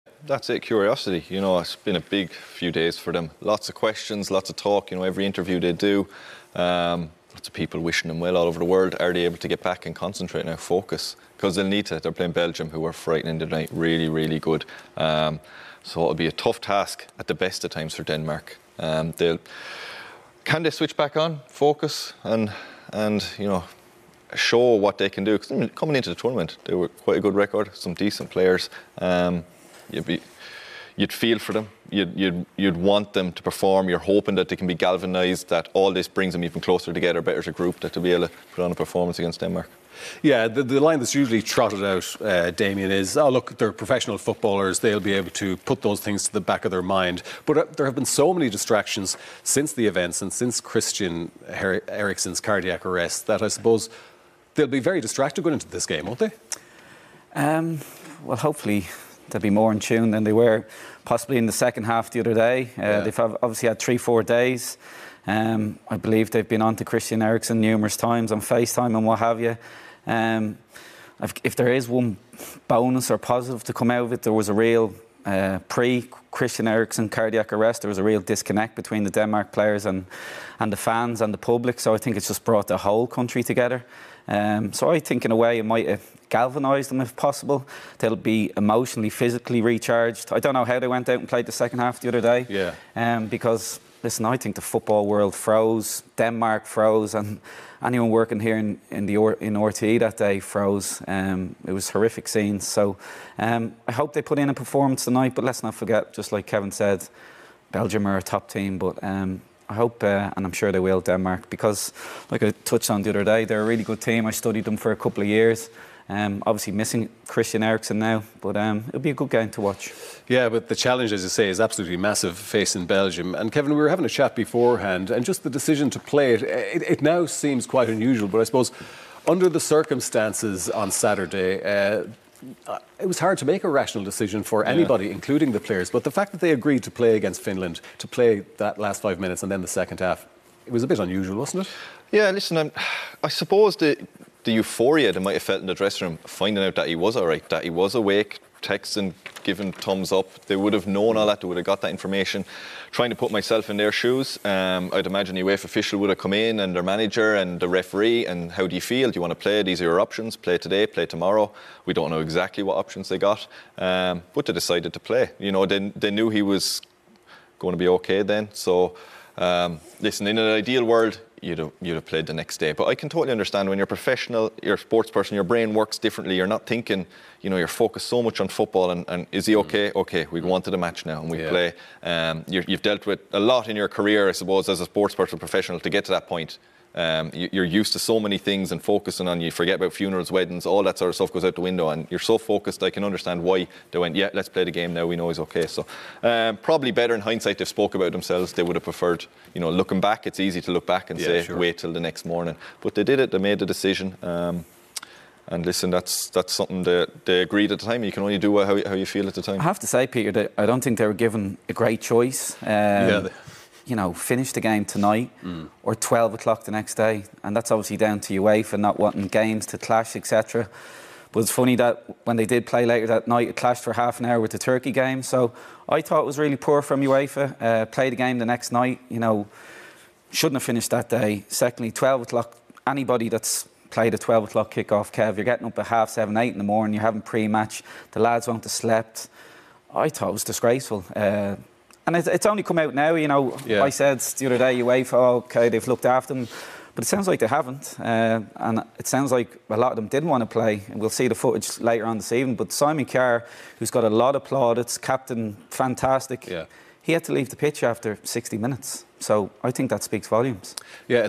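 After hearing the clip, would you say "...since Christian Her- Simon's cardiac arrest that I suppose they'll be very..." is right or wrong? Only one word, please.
wrong.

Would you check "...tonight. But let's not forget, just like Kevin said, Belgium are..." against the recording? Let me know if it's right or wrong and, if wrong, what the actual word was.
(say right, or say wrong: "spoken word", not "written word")
right.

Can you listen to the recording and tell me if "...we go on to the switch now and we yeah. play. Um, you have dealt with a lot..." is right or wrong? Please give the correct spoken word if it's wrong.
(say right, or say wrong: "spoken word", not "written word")
wrong: "match", not "switch".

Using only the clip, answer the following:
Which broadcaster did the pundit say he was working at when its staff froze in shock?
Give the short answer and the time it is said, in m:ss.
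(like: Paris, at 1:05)
RTE, at 1:39.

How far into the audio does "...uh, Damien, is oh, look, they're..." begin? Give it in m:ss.
0:42.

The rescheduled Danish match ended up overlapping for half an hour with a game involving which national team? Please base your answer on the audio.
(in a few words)
Turkey.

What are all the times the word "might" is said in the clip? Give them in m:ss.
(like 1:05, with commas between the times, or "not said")
1:25, 2:25.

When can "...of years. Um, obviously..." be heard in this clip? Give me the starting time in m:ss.
1:55.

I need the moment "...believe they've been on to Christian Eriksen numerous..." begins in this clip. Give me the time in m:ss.
1:05.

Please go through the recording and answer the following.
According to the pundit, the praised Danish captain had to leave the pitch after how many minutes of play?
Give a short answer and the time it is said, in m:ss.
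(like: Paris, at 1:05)
60 minutes, at 4:18.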